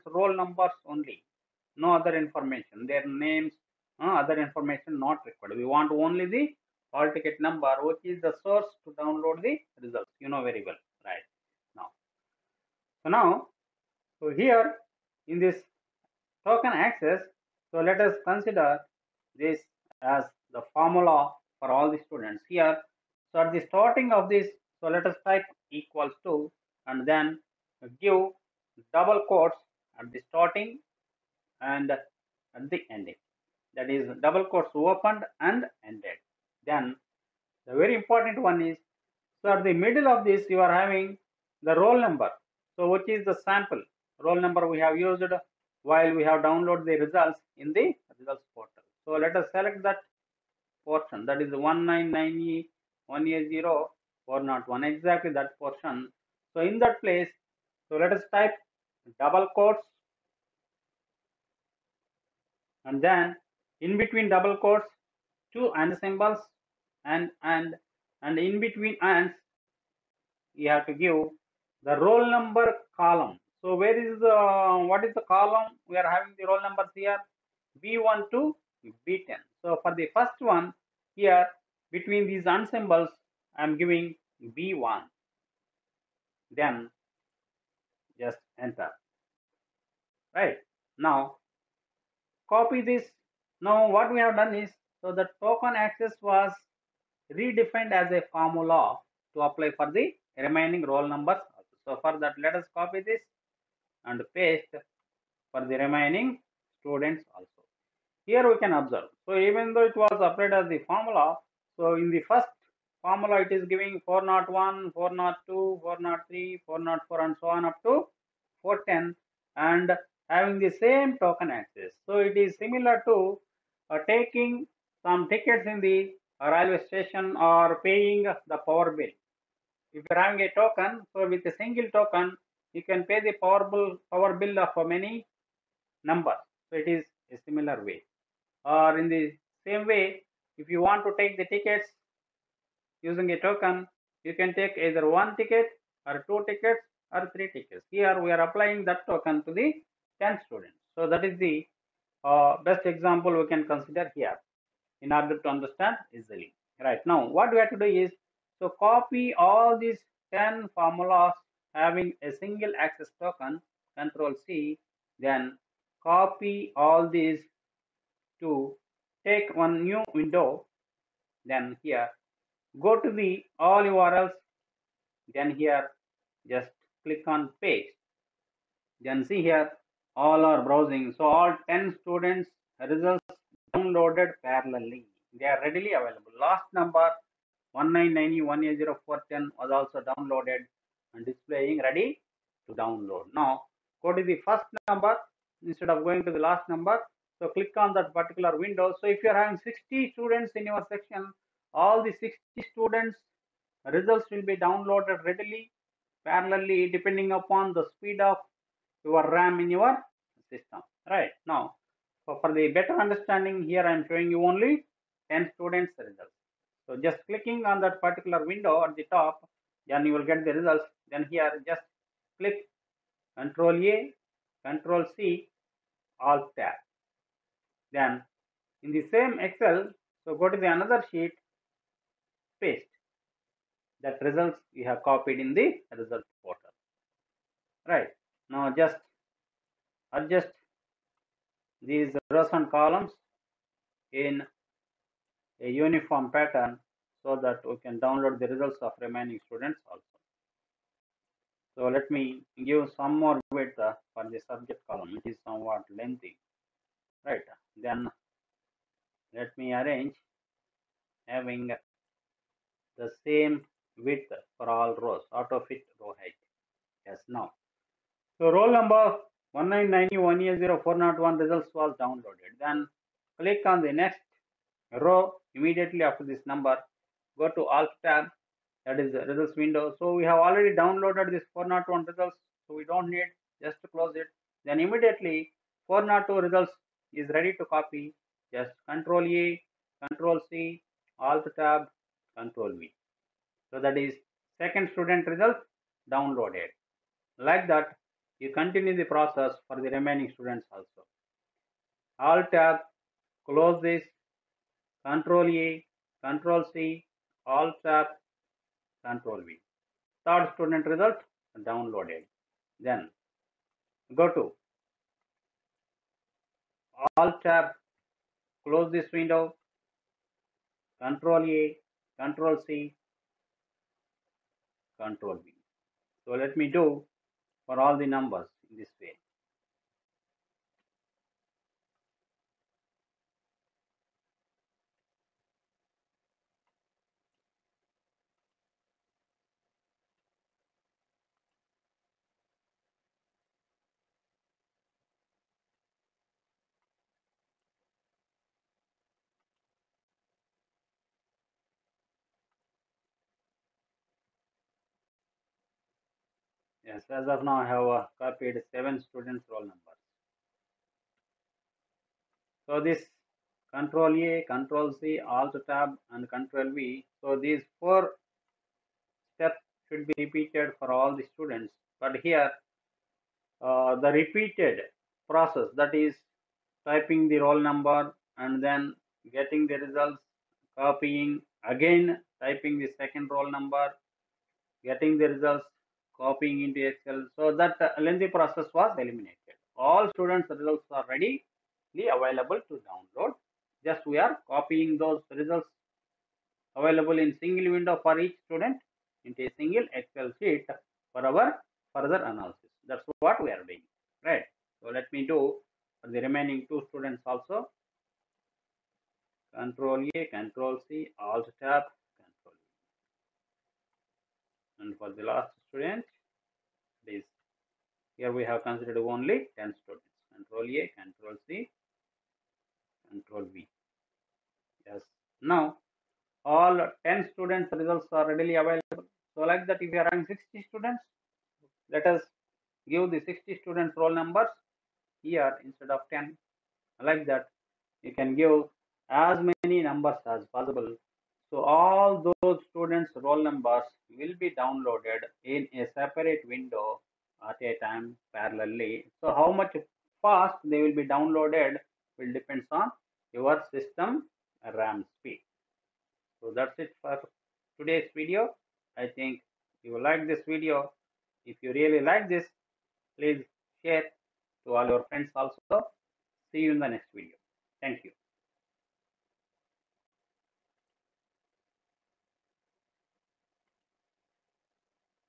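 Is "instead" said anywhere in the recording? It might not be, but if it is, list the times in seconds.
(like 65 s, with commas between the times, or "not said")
195 s, 435 s.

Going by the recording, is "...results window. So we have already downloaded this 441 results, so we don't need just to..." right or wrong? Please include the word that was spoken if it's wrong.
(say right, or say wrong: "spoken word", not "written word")
wrong: "401", not "441".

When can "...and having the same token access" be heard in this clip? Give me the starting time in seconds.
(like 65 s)
119 s.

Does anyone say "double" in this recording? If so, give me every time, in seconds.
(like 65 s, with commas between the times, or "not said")
28 s, 34 s, 59 s, 64 s.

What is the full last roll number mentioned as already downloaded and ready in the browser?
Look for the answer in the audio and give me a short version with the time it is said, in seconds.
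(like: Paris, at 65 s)
199100410, at 187 s.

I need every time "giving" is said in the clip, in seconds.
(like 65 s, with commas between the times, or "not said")
83 s, 113 s.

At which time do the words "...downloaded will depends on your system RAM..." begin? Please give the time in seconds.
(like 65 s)
451 s.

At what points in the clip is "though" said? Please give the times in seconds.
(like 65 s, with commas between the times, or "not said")
109 s.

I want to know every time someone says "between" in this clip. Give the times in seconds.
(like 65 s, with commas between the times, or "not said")
63 s, 68 s, 81 s.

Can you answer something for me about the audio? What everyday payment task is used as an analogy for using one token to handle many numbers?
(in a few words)
paying the power bill.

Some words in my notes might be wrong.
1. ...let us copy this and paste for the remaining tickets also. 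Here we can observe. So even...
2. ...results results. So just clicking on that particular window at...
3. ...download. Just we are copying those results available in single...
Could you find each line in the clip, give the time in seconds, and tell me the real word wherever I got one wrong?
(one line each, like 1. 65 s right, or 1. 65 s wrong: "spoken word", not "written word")
1. 102 s wrong: "students", not "tickets"
2. 215 s wrong: "students", not "results"
3. 392 s right.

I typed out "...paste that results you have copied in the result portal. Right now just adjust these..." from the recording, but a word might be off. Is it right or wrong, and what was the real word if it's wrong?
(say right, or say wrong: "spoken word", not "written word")
right.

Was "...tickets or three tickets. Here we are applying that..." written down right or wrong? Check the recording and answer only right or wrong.
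right.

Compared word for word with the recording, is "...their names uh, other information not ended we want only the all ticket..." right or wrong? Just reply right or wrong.
wrong.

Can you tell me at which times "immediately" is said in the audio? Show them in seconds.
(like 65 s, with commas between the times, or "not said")
275 s, 284 s.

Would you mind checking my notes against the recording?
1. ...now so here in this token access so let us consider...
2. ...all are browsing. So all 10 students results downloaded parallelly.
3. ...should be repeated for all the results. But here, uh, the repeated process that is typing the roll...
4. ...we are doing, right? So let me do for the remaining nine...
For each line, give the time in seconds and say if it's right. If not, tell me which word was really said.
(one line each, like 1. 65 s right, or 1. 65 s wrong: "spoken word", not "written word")
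1. 13 s right
2. 180 s right
3. 369 s wrong: "students", not "results"
4. 403 s wrong: "two", not "nine".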